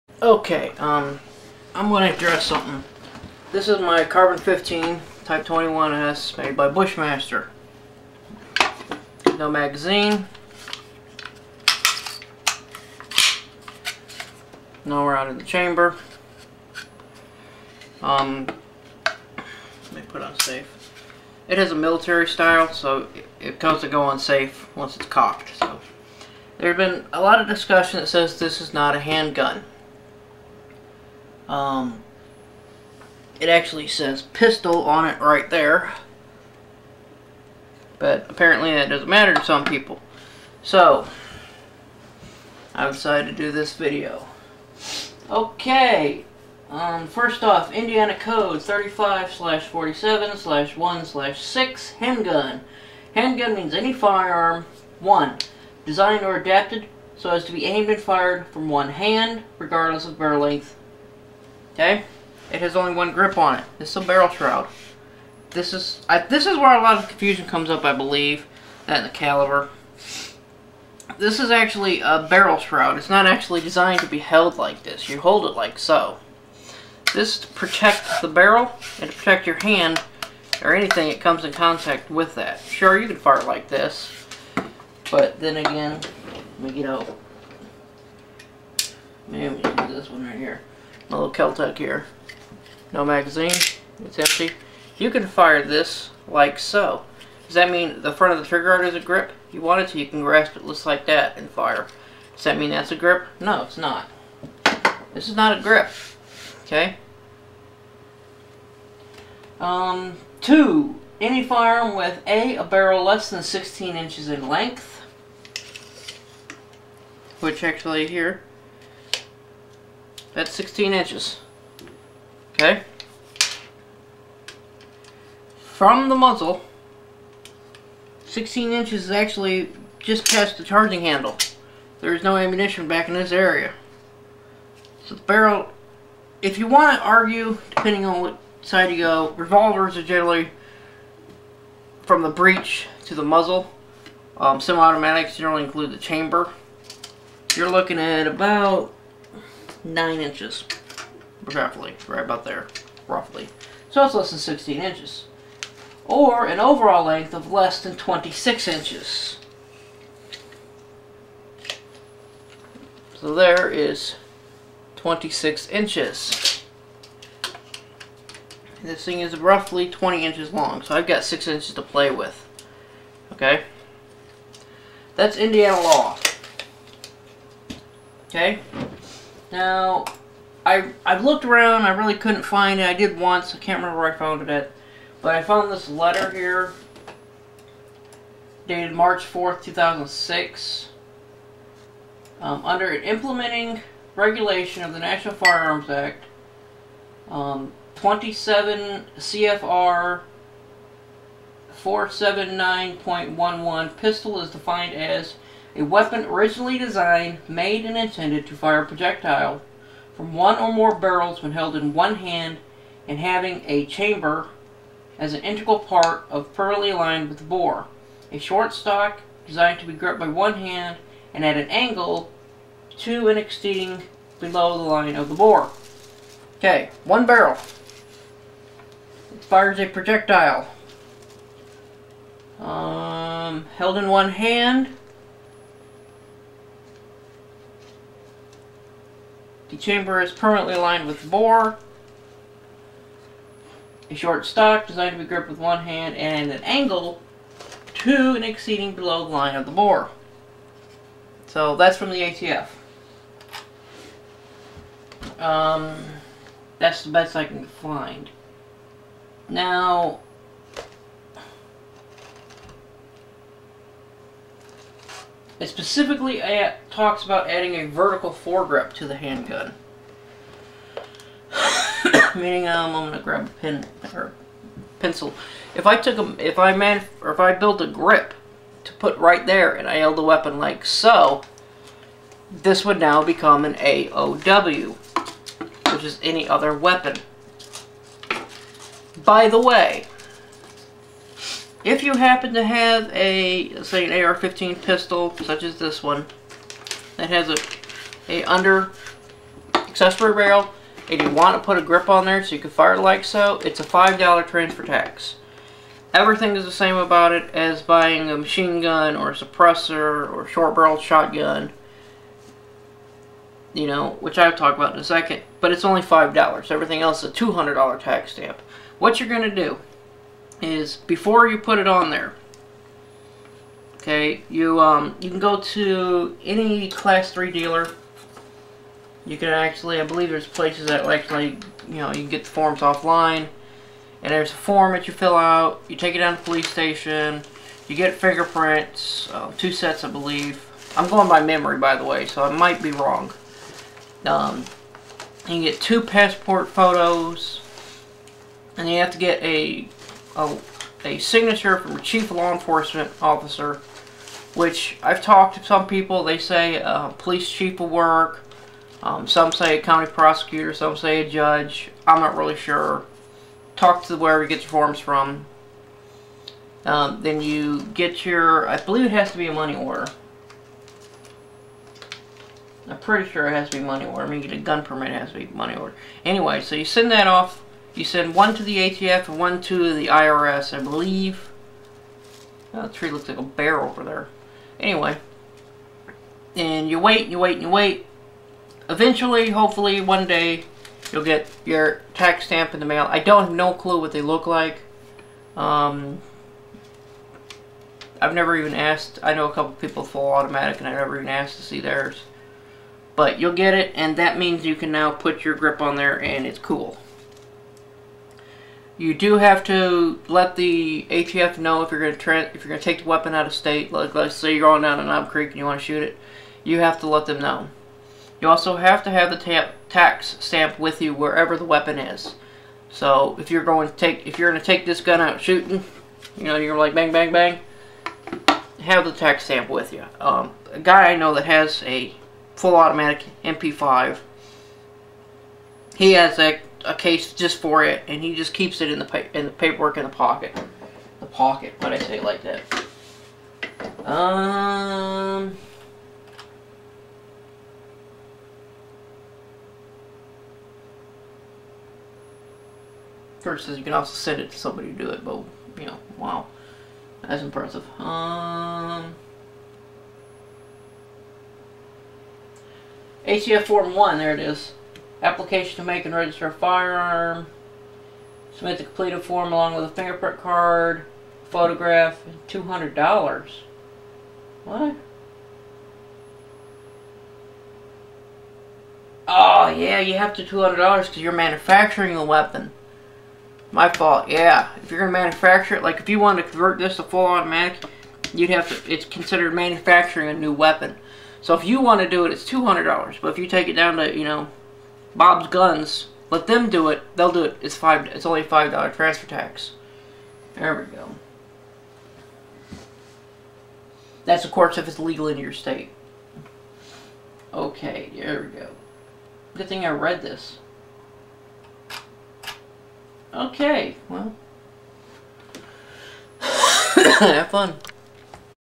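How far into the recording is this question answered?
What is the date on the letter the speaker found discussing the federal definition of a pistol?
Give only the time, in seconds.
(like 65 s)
188 s.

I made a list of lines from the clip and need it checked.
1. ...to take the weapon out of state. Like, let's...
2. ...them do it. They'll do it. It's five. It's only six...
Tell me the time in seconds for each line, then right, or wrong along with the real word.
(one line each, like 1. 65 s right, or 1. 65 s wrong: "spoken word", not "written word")
1. 412 s right
2. 496 s wrong: "five", not "six".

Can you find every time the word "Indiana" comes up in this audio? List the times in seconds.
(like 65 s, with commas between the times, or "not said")
47 s, 175 s.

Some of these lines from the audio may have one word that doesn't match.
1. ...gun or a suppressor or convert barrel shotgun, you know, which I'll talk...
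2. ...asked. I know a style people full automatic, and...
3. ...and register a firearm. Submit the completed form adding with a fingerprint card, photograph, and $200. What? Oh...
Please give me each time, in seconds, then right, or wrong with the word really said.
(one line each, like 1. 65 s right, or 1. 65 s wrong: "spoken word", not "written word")
1. 308 s wrong: "short", not "convert"
2. 398 s wrong: "couple", not "style"
3. 466 s wrong: "along", not "adding".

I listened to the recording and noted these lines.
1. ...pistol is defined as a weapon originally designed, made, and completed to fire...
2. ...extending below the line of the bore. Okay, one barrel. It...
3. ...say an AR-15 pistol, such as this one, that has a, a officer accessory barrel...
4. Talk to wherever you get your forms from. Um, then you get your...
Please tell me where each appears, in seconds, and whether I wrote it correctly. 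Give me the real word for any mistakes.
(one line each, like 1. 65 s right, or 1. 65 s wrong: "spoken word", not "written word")
1. 203 s wrong: "intended", not "completed"
2. 223 s right
3. 293 s wrong: "under", not "officer"
4. 363 s right.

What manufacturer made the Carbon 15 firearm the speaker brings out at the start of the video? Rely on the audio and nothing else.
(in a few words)
Bushmaster.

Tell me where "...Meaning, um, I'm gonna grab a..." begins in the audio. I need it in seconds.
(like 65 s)
272 s.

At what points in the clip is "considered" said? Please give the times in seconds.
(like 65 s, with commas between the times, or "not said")
489 s.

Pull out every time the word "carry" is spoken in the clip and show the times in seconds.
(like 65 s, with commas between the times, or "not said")
not said.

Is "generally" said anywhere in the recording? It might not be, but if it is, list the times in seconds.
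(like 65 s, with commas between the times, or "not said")
140 s, 145 s.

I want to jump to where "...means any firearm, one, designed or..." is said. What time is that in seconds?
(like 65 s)
53 s.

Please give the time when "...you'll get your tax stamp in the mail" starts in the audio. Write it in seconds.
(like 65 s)
391 s.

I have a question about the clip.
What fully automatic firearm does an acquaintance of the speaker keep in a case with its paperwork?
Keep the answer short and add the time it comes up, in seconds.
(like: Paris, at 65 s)
MP5, at 433 s.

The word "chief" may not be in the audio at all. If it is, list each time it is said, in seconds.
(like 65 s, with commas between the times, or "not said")
352 s, 357 s.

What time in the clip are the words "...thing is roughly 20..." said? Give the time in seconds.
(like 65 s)
169 s.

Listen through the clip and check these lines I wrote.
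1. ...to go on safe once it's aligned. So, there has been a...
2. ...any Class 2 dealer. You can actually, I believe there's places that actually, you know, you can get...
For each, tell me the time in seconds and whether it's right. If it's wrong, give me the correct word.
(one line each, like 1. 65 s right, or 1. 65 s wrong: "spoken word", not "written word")
1. 23 s wrong: "cocked", not "aligned"
2. 326 s wrong: "3", not "2".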